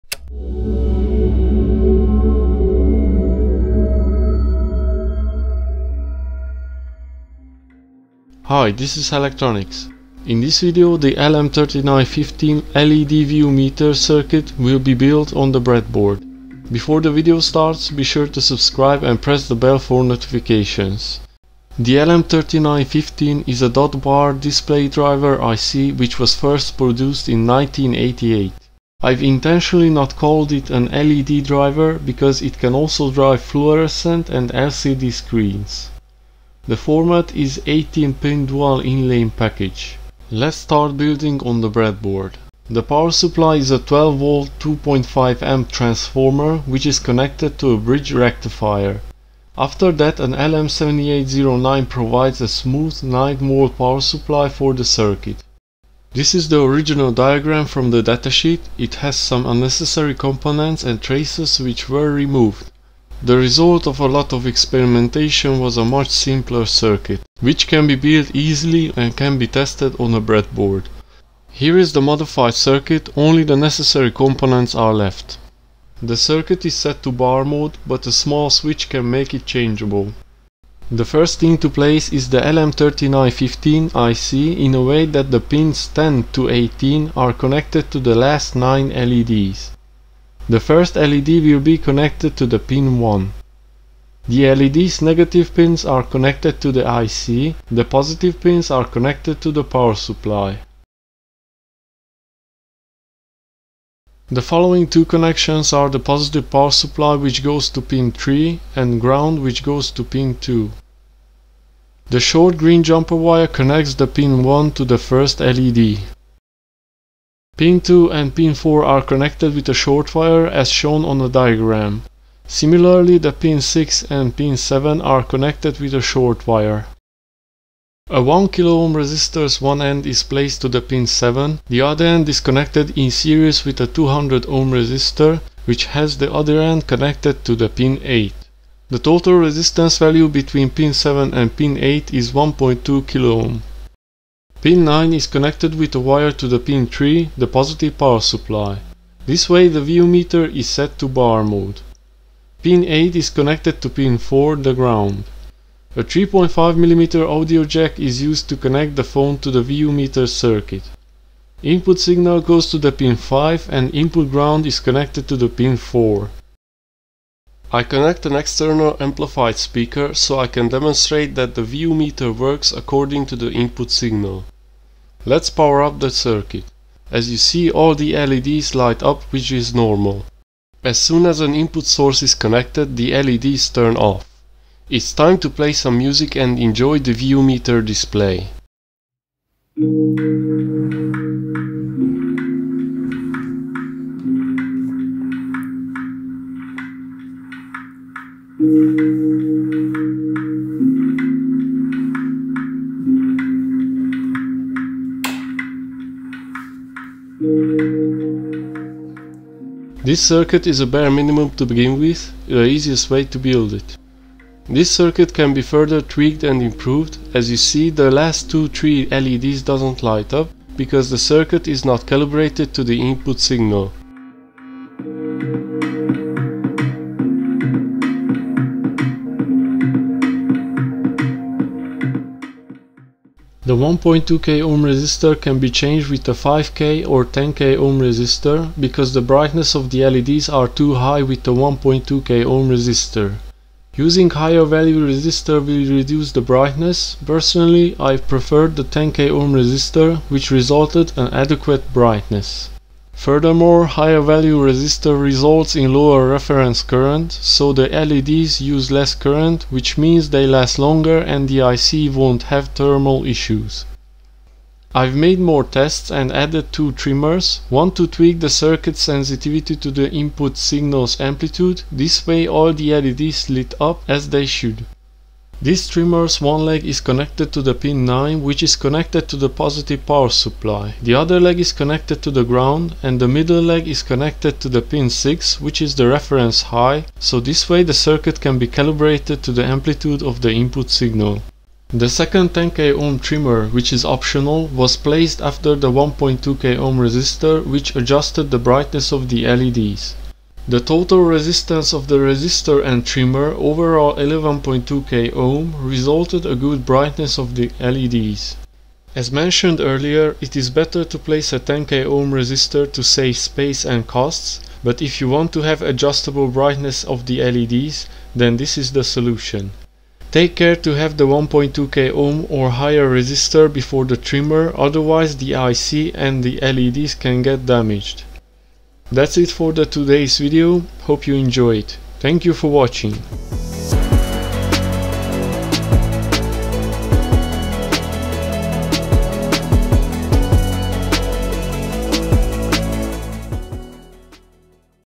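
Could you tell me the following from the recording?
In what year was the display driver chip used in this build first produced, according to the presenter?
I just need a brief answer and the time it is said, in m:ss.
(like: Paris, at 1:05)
1988, at 0:27.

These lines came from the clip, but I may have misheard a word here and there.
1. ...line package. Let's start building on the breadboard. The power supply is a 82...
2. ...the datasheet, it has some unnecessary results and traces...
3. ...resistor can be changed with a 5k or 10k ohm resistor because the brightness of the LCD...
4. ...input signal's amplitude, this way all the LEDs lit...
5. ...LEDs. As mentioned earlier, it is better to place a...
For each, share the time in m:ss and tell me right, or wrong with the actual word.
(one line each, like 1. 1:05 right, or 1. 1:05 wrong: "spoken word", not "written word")
1. 0:39 wrong: "12", not "82"
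2. 0:57 wrong: "components", not "results"
3. 3:54 wrong: "LEDs", not "LCD"
4. 4:30 right
5. 5:07 right.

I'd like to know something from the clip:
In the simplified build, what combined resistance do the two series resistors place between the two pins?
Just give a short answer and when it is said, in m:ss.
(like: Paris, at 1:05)
1.2 kilo ohm, at 2:22.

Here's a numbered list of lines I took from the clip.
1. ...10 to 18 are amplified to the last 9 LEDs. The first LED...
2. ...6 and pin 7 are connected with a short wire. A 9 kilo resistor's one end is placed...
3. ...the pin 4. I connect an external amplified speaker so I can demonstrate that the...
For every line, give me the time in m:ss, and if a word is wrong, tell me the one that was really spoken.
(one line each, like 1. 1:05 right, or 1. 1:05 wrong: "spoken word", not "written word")
1. 1:25 wrong: "connected", not "amplified"
2. 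2:03 wrong: "1", not "9"
3. 2:45 right.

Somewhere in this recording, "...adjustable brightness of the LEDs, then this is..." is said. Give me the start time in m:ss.
5:15.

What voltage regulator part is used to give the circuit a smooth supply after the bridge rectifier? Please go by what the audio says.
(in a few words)
LM7809.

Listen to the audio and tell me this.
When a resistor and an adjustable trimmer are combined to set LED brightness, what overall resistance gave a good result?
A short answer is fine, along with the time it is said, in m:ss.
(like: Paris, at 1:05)
11.2k ohm, at 5:04.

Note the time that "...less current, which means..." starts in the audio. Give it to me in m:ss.
4:18.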